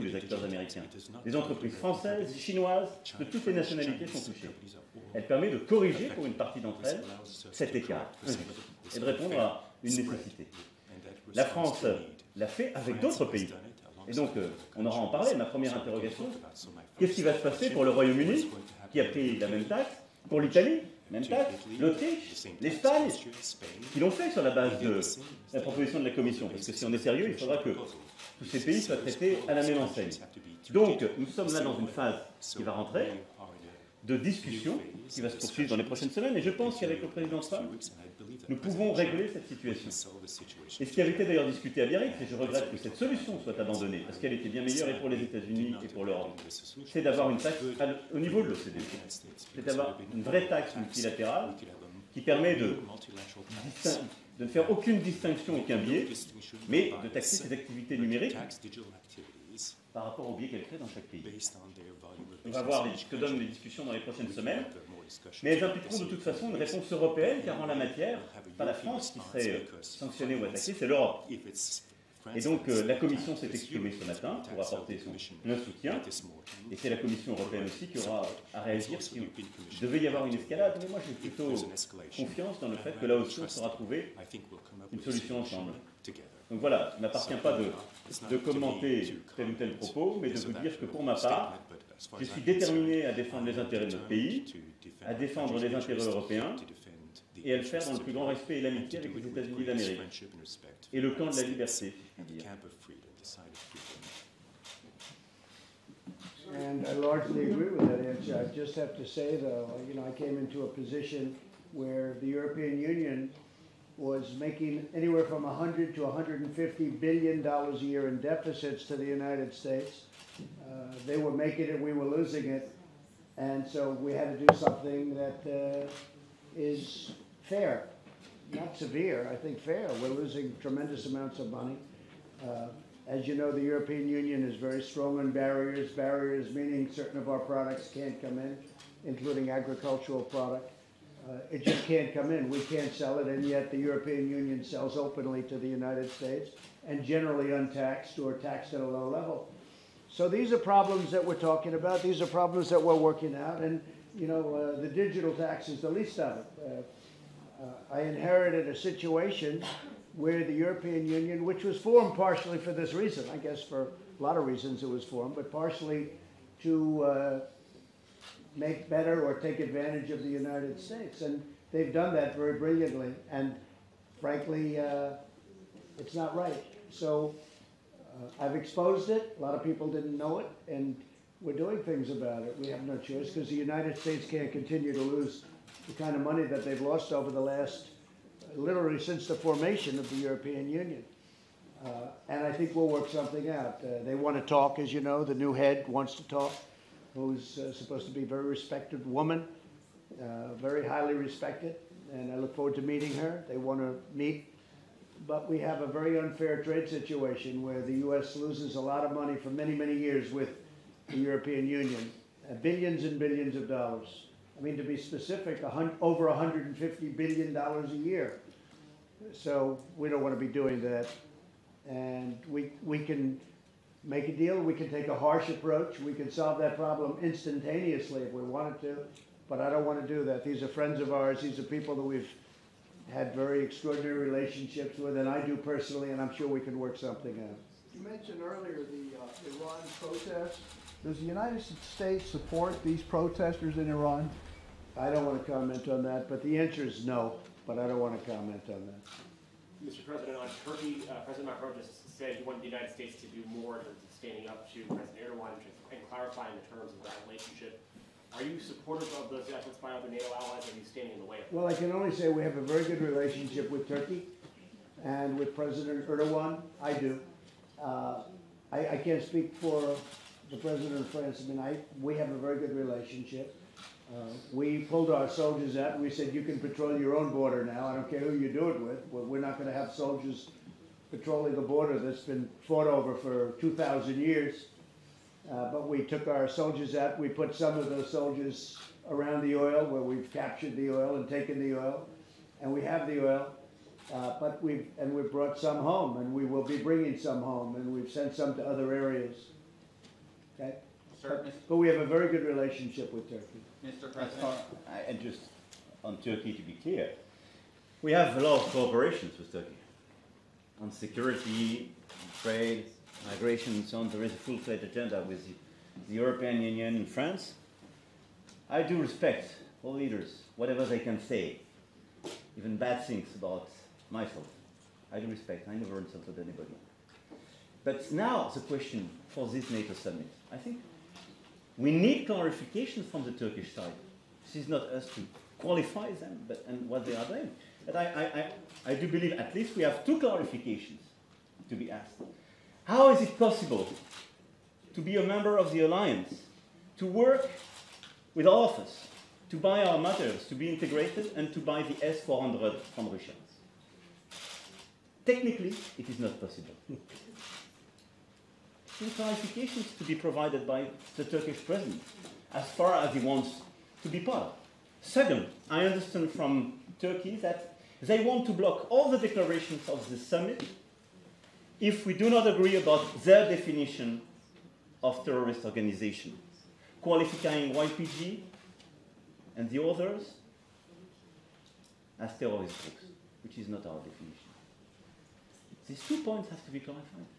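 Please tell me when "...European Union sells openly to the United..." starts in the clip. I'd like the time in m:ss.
2:23.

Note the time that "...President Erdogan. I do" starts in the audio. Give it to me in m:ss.
4:25.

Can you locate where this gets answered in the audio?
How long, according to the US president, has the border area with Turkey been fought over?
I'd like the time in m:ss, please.
4:43.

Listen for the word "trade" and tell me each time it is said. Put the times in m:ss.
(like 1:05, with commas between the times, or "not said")
3:26, 5:12.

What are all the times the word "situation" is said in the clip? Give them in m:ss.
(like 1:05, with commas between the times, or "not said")
0:39, 2:38, 3:26.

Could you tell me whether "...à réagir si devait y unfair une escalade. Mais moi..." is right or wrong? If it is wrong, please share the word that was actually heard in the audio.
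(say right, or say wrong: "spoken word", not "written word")
wrong: "avoir", not "unfair".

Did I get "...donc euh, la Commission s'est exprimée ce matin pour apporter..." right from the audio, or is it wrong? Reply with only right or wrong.
right.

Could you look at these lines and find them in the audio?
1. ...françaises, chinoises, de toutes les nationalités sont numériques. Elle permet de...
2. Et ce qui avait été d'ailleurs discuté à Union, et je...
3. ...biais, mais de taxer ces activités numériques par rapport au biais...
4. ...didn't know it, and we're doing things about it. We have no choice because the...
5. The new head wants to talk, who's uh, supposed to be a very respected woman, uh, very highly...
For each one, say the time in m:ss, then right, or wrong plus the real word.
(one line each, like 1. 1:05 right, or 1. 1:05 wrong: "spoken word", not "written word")
1. 0:01 wrong: "touchées", not "numériques"
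2. 0:40 wrong: "Biarritz", not "Union"
3. 0:55 right
4. 2:59 right
5. 3:15 right.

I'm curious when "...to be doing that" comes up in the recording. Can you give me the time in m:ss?
3:40.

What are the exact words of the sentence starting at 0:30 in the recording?
Donc, nous sommes là dans une phase qui va rentrer, de discussion qui va se poursuivre dans les prochaines semaines.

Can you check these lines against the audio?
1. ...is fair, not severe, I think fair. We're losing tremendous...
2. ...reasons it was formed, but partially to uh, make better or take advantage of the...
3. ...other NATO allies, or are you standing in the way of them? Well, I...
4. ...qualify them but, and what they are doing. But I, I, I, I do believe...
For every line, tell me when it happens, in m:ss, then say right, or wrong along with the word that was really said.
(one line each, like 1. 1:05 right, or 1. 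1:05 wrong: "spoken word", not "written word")
1. 2:06 right
2. 2:44 right
3. 4:19 right
4. 5:35 right.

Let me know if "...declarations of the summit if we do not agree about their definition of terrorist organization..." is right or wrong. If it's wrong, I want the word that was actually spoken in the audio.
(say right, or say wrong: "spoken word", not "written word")
right.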